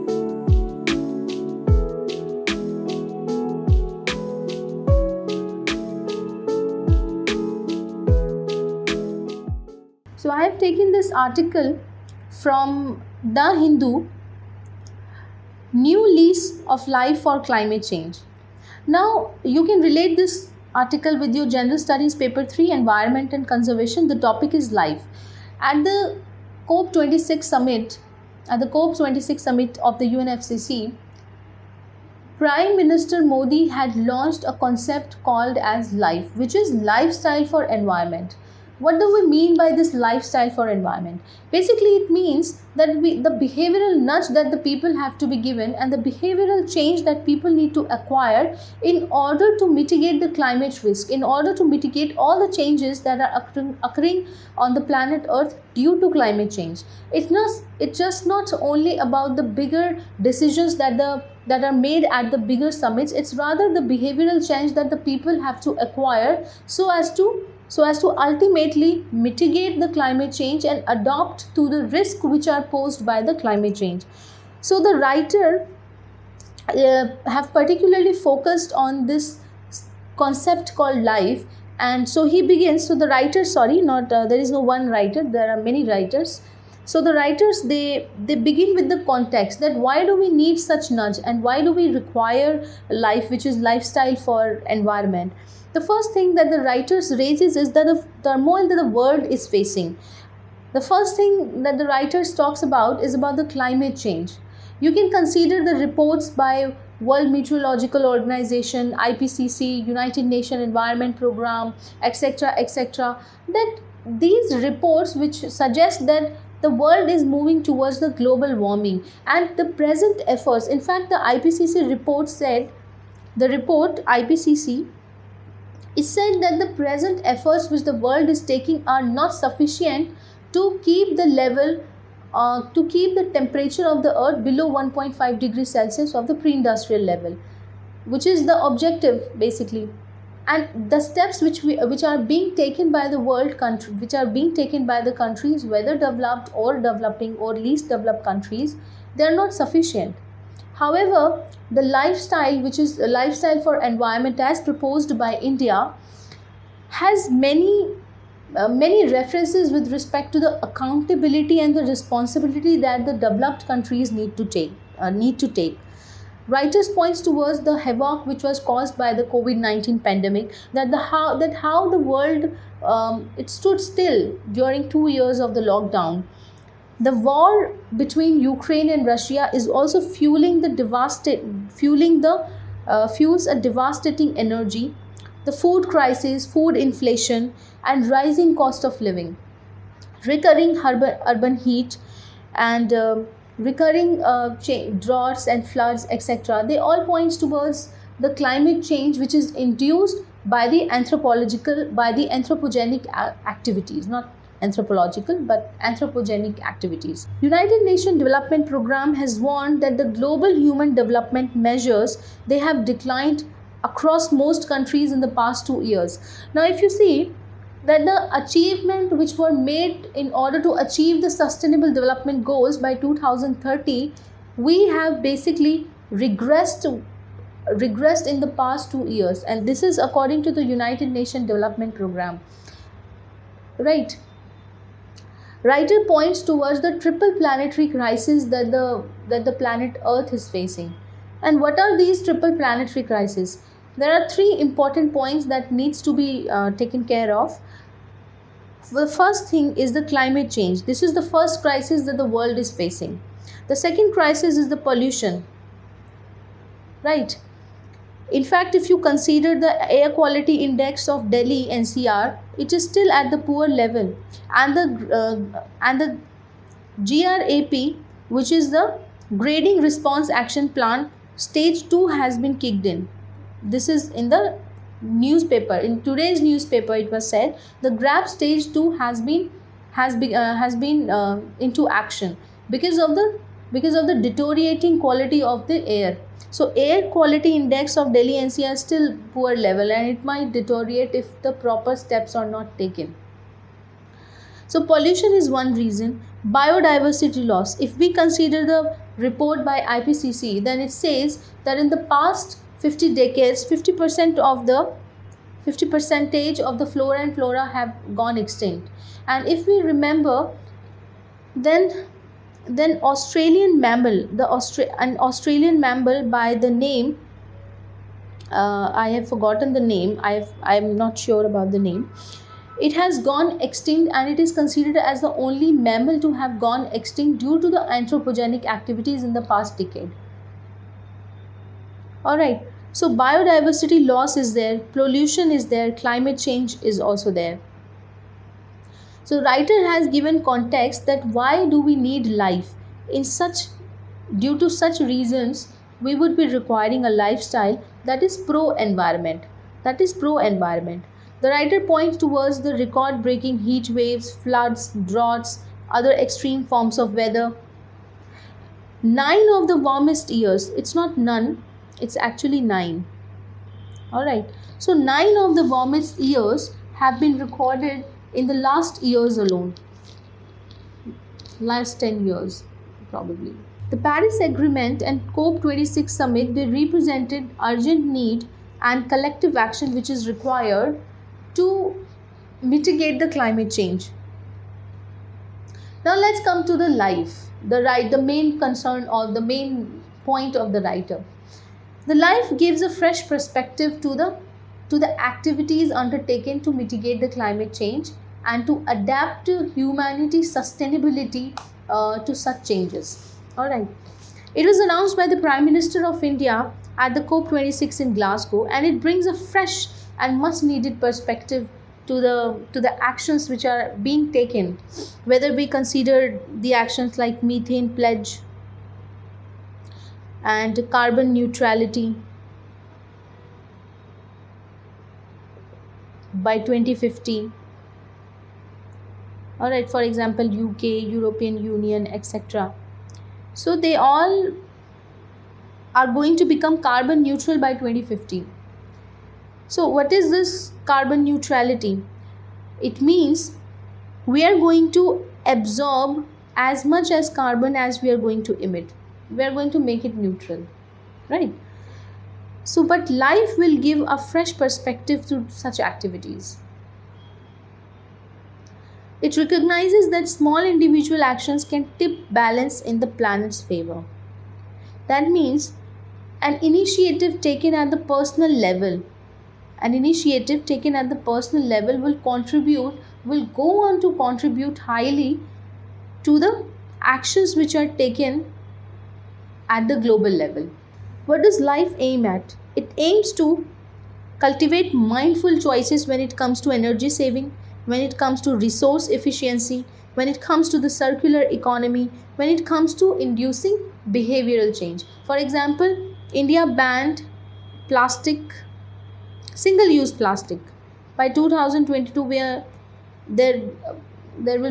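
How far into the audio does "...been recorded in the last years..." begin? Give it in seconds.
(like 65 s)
367 s.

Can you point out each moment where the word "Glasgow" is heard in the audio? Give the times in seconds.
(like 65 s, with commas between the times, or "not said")
408 s.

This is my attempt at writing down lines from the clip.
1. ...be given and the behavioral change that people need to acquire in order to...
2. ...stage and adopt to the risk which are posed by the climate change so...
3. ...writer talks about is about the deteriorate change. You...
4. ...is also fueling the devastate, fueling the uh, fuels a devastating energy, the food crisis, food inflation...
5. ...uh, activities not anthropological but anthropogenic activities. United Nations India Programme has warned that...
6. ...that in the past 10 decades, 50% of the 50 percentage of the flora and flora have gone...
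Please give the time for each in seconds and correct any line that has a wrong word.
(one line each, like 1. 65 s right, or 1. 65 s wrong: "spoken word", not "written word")
1. 45 s right
2. 70 s wrong: "change", not "stage"
3. 101 s wrong: "climate", not "deteriorate"
4. 179 s right
5. 203 s wrong: "Development", not "India"
6. 301 s wrong: "50", not "10".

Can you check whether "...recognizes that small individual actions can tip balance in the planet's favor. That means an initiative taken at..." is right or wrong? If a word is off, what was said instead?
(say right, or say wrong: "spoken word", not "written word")
right.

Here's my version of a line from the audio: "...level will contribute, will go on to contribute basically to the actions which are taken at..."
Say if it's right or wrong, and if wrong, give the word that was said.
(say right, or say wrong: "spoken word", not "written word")
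wrong: "highly", not "basically".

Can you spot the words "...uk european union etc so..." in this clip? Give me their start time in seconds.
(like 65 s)
430 s.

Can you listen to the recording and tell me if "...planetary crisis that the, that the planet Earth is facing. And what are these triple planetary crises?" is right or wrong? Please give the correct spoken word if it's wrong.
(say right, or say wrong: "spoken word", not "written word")
right.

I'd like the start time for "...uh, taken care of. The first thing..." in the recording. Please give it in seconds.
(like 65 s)
246 s.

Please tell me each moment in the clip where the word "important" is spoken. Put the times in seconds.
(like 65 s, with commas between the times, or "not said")
244 s.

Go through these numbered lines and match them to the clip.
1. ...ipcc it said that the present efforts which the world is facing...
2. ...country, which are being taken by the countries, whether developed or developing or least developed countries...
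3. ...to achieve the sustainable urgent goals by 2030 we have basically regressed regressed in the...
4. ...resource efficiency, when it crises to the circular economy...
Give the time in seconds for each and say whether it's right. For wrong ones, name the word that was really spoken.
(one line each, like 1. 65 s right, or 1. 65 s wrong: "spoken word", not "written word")
1. 124 s wrong: "taking", not "facing"
2. 143 s right
3. 220 s wrong: "development", not "urgent"
4. 488 s wrong: "comes", not "crises".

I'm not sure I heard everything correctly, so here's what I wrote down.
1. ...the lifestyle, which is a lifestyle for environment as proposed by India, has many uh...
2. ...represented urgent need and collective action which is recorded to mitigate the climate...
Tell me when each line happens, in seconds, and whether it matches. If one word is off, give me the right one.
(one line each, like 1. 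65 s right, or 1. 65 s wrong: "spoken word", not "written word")
1. 151 s right
2. 376 s wrong: "required", not "recorded".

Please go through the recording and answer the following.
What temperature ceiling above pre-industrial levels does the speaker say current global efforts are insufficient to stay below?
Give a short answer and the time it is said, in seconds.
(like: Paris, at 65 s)
1.5 degrees Celsius, at 134 s.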